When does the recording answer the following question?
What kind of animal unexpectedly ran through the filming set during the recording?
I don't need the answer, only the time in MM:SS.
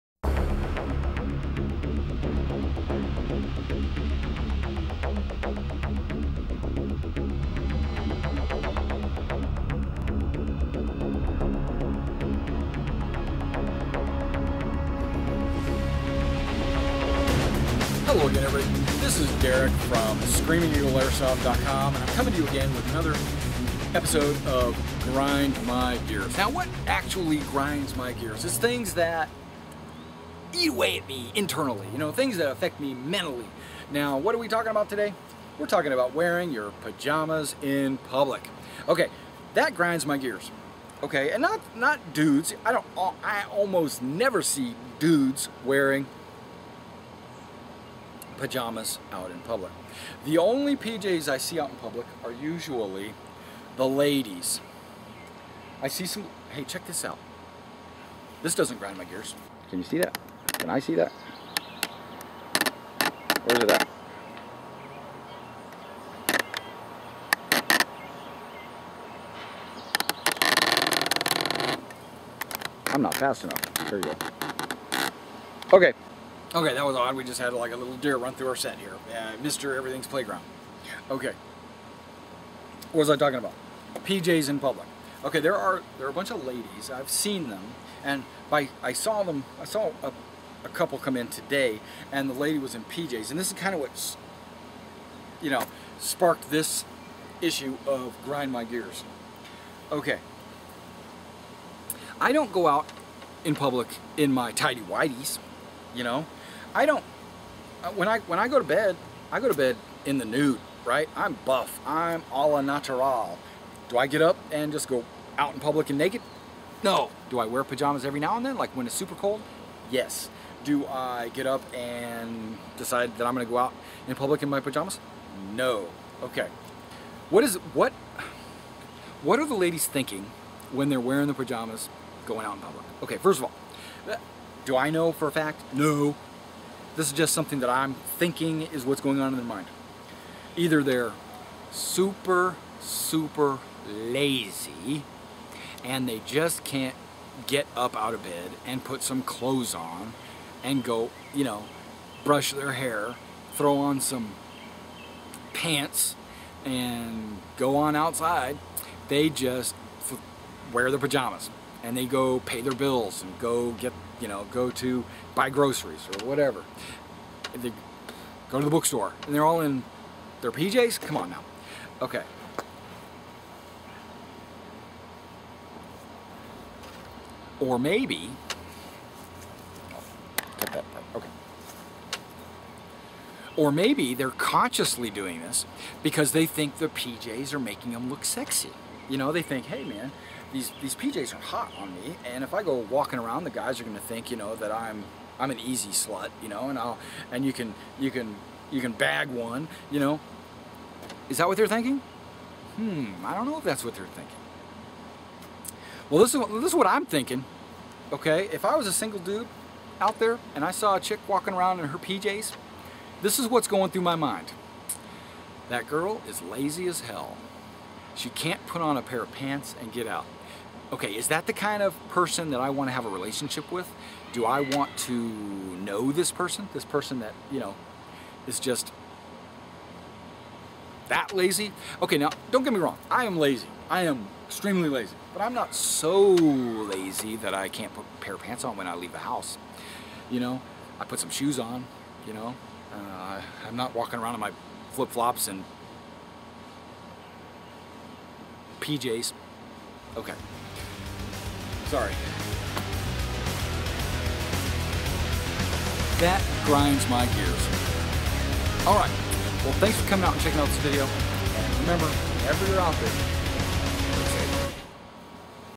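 01:17.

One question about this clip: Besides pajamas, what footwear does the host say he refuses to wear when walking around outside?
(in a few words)
flip-flops.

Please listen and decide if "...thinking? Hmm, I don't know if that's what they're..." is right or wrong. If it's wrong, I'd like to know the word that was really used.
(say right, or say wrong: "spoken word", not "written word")
right.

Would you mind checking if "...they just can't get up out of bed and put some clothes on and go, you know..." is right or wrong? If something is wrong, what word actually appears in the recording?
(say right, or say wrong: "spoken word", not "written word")
right.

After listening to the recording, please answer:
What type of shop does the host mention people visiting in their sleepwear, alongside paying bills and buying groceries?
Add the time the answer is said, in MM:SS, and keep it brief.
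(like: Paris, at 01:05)
bookstore, at 02:48.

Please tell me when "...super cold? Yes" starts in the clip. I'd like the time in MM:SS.
01:58.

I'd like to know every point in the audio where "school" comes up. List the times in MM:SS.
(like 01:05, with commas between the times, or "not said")
not said.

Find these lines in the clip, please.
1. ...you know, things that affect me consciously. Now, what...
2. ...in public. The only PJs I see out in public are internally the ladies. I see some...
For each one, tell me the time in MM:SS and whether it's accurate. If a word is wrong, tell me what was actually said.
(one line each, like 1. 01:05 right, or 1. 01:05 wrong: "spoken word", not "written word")
1. 00:31 wrong: "mentally", not "consciously"
2. 00:49 wrong: "usually", not "internally".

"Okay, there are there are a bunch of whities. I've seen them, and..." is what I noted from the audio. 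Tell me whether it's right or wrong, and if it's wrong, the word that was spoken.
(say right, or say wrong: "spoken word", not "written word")
wrong: "ladies", not "whities".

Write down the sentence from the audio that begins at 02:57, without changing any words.
Or maybe, Cut that part, okay.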